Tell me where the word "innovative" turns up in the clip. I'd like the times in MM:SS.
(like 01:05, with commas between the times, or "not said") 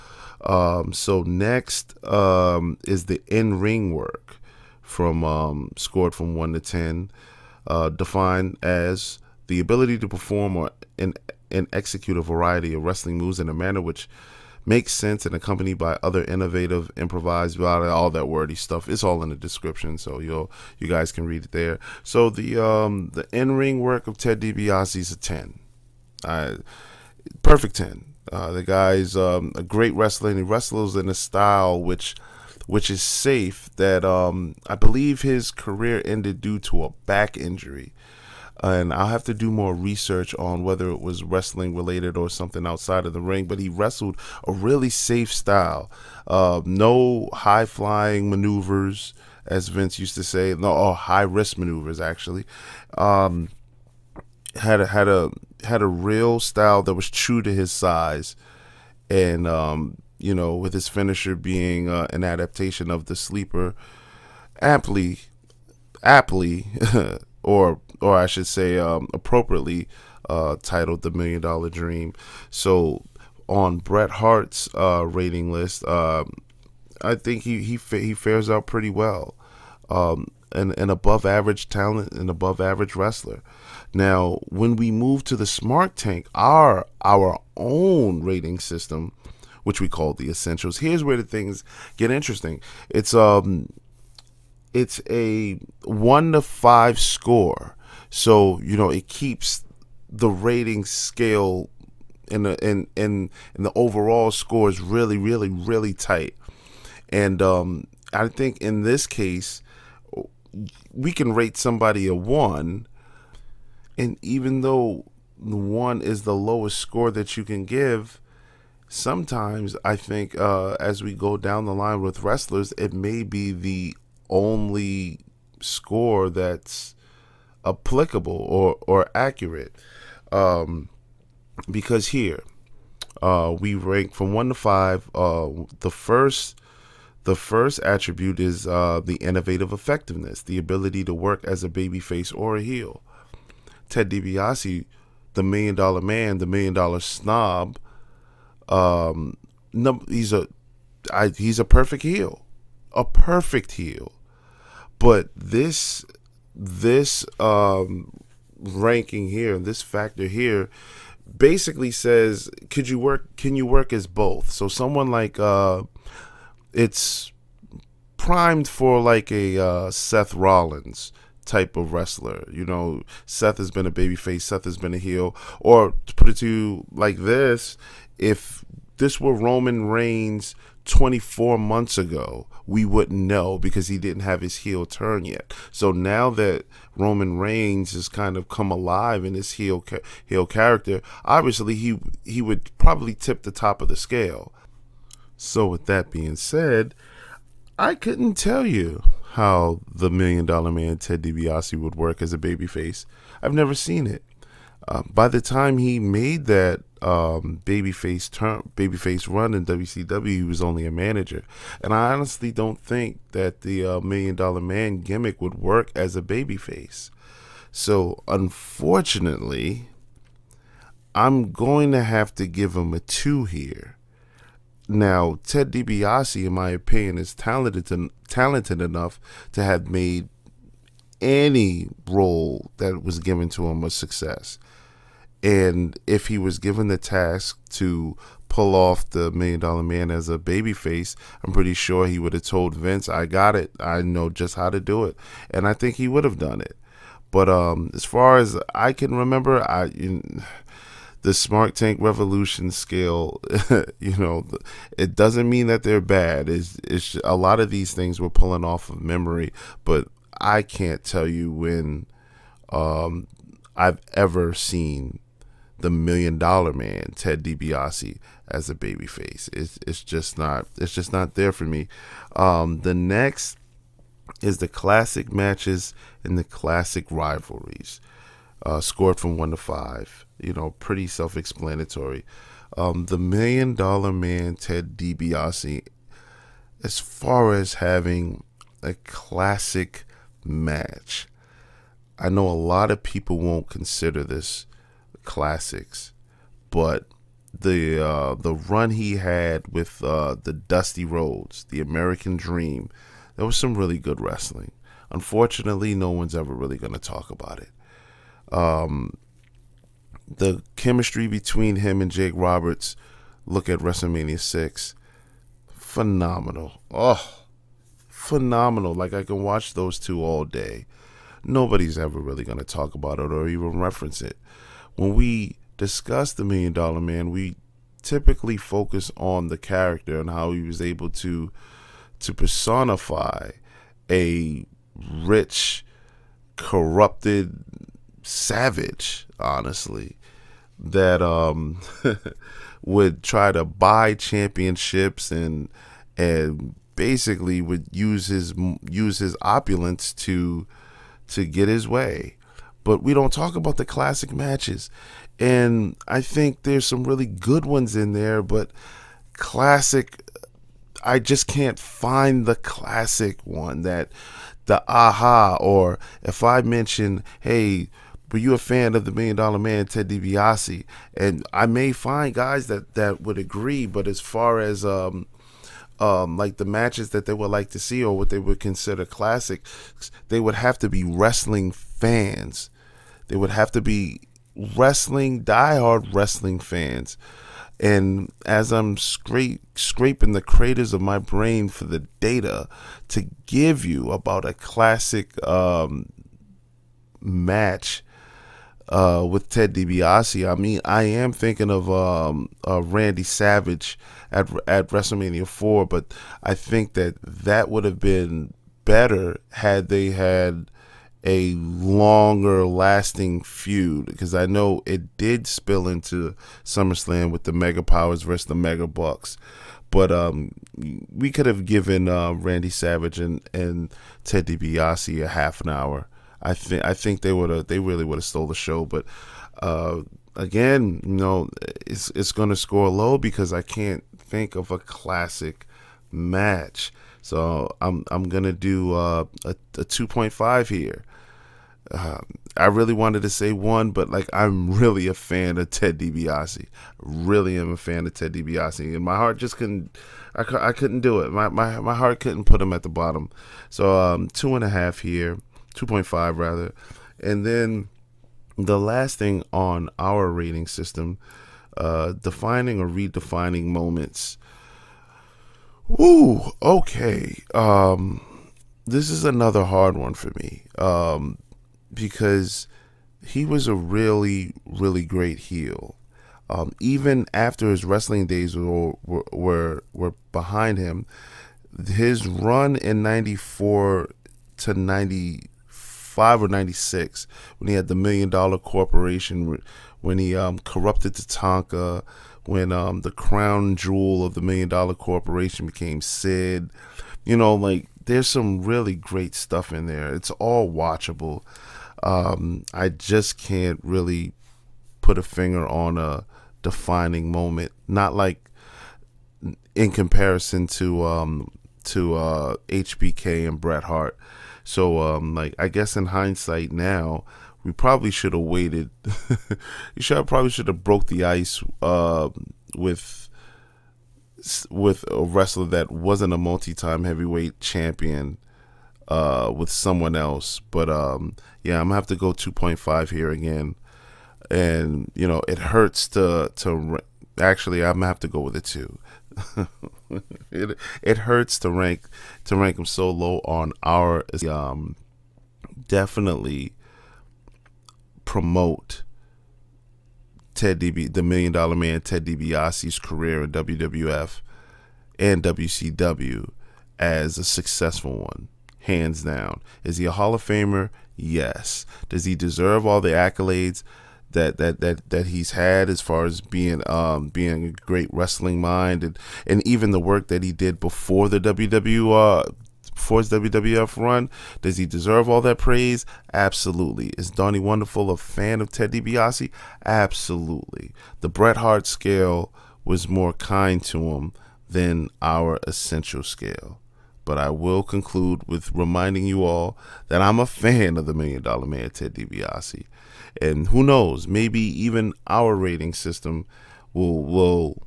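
00:16, 02:19.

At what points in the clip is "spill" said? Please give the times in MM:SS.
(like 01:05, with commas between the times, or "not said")
06:55.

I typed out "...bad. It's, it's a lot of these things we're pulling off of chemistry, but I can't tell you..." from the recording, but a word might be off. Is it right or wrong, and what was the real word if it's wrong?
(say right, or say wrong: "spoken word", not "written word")
wrong: "memory", not "chemistry".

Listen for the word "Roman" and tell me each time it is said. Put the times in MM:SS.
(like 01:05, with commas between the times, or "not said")
02:59, 03:06.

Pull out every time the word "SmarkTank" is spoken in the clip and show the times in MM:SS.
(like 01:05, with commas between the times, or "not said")
01:25, 04:11.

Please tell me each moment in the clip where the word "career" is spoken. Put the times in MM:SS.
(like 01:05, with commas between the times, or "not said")
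00:35, 09:12.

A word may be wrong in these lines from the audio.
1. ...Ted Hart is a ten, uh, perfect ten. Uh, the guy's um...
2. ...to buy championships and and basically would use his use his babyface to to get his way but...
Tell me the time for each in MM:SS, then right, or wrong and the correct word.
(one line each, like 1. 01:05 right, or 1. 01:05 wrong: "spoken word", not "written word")
1. 00:24 wrong: "DiBiase", not "Hart"
2. 05:43 wrong: "opulence", not "babyface".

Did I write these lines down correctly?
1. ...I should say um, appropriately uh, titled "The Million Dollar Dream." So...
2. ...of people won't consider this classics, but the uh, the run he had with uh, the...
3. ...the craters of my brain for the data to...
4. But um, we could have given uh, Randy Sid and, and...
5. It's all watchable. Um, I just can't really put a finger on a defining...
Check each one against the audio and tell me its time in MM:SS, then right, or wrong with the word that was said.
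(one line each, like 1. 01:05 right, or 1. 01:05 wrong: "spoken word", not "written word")
1. 01:08 right
2. 04:52 right
3. 06:30 right
4. 06:59 wrong: "Savage", not "Sid"
5. 08:20 right.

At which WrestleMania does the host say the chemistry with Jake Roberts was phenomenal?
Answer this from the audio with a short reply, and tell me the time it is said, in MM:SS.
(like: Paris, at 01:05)
WrestleMania 6, at 05:13.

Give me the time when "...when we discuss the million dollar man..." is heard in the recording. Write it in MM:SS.
05:24.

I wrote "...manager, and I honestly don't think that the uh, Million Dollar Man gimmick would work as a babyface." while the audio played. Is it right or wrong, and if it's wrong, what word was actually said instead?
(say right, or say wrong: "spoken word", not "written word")
right.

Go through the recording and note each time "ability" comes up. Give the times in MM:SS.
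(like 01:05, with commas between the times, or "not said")
00:09, 02:20.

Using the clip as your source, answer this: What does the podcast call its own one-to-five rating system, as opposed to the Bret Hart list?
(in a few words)
The Essentials.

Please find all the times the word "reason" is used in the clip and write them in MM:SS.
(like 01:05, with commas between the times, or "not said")
not said.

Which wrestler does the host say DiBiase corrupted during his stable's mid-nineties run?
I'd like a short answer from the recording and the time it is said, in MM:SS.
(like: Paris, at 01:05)
Tatanka, at 08:11.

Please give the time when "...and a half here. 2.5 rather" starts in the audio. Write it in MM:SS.
07:34.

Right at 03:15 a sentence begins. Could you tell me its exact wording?
So with that being said, I couldn't tell you how the Million Dollar Man Ted DiBiase would work as a babyface.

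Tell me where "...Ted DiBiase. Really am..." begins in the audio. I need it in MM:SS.
07:25.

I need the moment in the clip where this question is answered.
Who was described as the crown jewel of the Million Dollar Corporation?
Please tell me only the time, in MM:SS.
08:16.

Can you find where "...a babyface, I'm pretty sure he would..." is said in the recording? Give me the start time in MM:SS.
04:00.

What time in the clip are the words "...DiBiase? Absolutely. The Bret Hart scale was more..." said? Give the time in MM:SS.
09:38.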